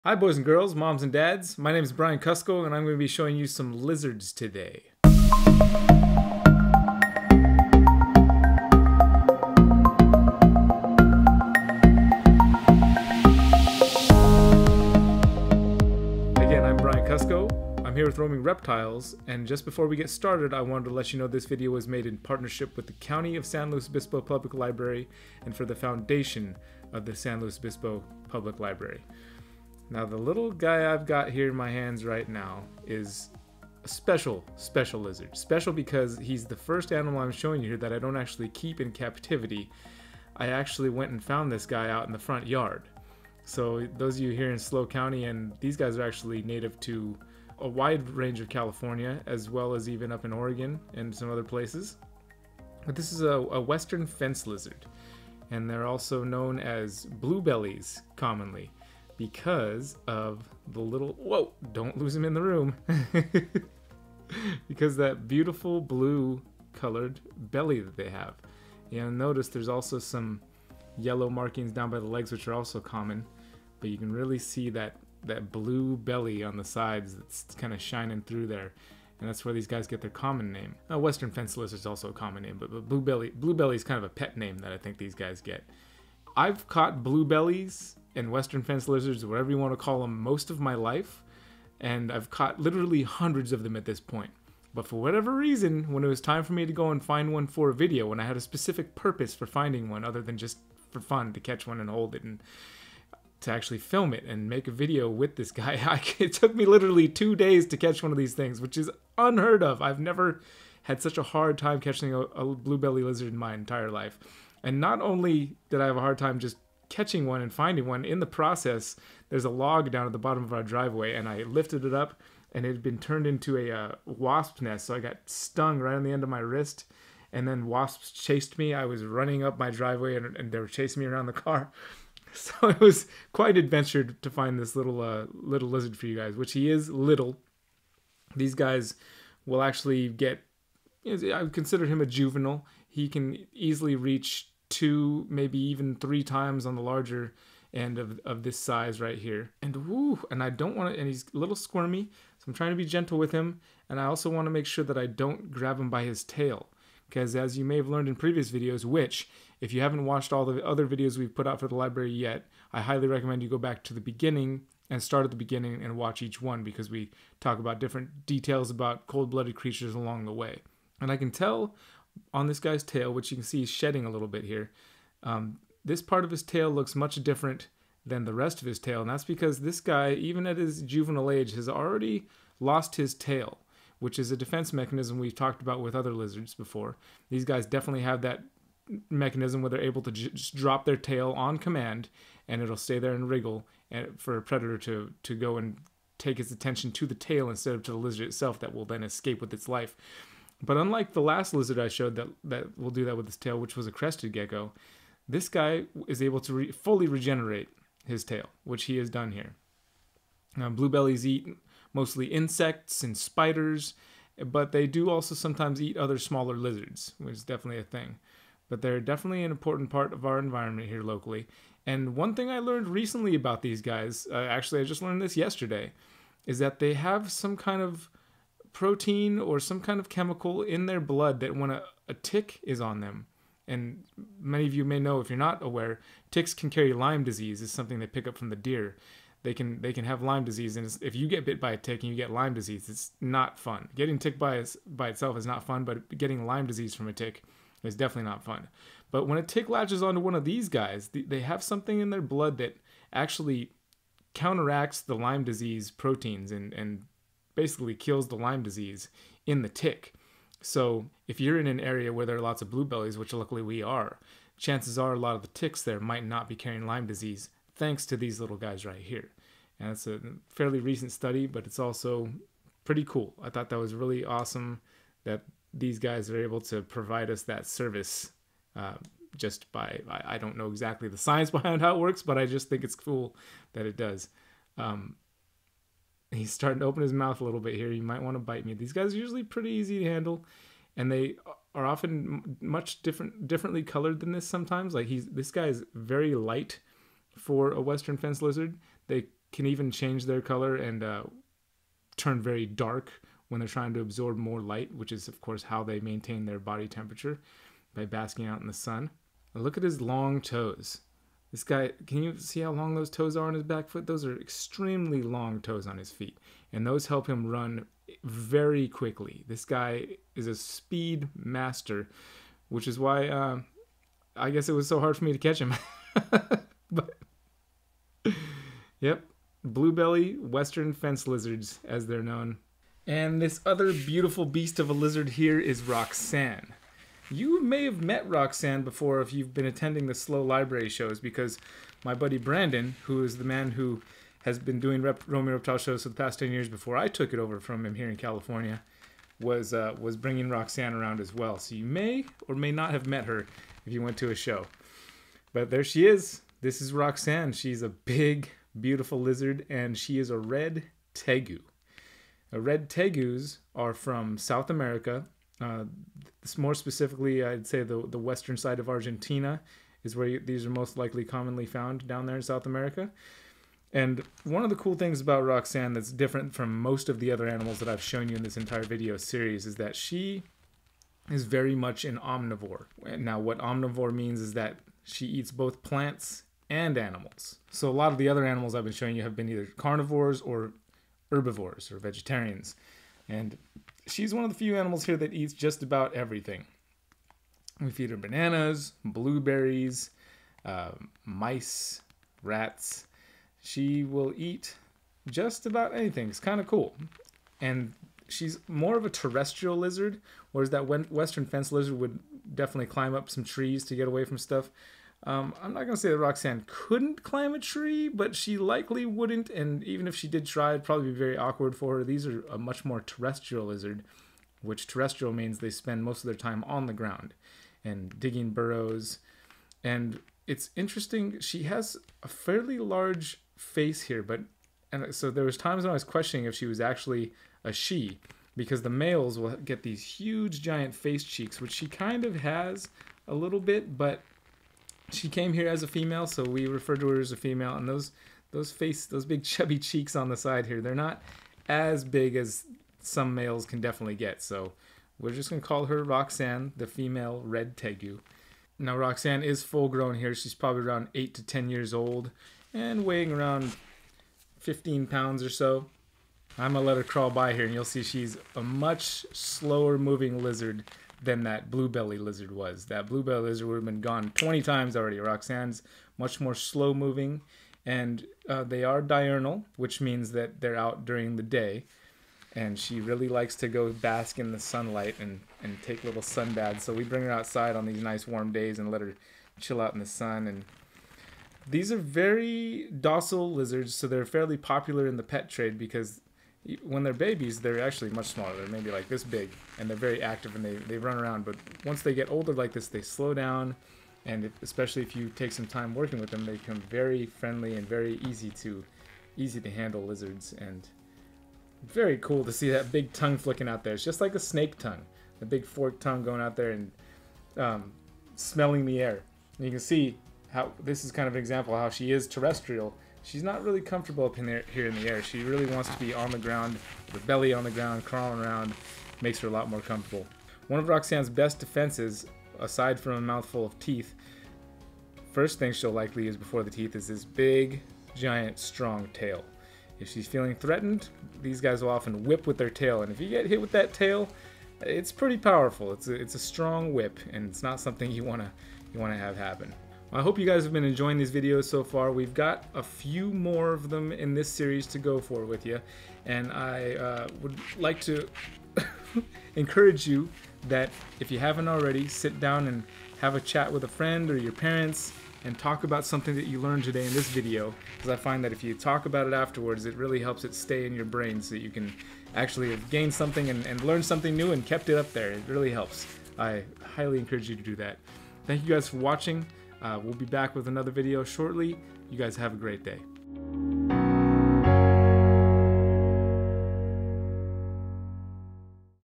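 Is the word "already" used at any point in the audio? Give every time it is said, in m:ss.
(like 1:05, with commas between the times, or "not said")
3:01, 7:54, 9:21.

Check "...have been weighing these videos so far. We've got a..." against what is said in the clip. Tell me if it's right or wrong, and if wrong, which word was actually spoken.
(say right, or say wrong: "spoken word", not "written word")
wrong: "enjoying", not "weighing".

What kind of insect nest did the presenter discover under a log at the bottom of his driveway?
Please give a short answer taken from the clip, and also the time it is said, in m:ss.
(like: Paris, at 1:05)
Wasp nest, at 2:04.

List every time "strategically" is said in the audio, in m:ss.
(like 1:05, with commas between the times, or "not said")
not said.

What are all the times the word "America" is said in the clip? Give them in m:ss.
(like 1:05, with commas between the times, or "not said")
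6:04, 6:12.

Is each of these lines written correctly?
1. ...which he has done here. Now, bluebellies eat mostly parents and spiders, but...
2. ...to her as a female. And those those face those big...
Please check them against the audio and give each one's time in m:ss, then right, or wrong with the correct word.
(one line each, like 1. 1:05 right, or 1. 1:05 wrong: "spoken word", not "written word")
1. 3:28 wrong: "insects", not "parents"
2. 7:26 right.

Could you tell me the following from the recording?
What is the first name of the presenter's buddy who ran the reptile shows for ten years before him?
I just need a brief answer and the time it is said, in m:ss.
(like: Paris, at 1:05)
Brandon, at 5:42.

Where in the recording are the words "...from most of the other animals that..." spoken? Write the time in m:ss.
6:16.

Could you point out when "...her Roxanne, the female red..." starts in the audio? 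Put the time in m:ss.
7:35.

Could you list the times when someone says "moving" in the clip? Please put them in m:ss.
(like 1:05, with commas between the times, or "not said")
7:49, 7:56.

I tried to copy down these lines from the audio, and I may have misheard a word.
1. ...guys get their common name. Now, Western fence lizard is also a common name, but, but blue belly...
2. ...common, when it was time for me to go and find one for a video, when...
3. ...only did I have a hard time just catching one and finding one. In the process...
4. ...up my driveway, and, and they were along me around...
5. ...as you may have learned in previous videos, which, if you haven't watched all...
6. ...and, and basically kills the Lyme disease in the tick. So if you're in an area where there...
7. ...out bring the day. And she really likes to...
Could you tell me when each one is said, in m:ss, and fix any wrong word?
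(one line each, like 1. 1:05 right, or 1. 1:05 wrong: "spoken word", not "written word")
1. 1:19 right
2. 1:35 wrong: "reason", not "common"
3. 1:55 right
4. 2:09 wrong: "chasing", not "along"
5. 2:37 right
6. 4:16 right
7. 8:00 wrong: "during", not "bring".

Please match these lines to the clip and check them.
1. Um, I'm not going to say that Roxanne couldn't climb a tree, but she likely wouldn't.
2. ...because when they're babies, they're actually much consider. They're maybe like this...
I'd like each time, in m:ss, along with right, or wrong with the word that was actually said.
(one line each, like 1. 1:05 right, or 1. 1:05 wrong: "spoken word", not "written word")
1. 6:55 right
2. 8:15 wrong: "smaller", not "consider".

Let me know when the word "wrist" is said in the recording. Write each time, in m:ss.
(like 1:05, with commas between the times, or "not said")
2:06.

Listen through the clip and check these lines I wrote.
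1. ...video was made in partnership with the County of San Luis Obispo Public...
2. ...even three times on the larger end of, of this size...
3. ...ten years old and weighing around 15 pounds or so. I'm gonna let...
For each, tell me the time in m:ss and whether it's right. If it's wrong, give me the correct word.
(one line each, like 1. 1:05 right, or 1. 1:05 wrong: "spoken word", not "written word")
1. 0:21 right
2. 2:25 right
3. 7:41 right.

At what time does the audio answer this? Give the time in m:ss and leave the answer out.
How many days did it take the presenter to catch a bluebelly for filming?
1:47.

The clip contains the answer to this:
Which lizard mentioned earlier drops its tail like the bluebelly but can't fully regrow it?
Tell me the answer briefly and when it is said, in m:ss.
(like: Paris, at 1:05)
Crested gecko, at 3:23.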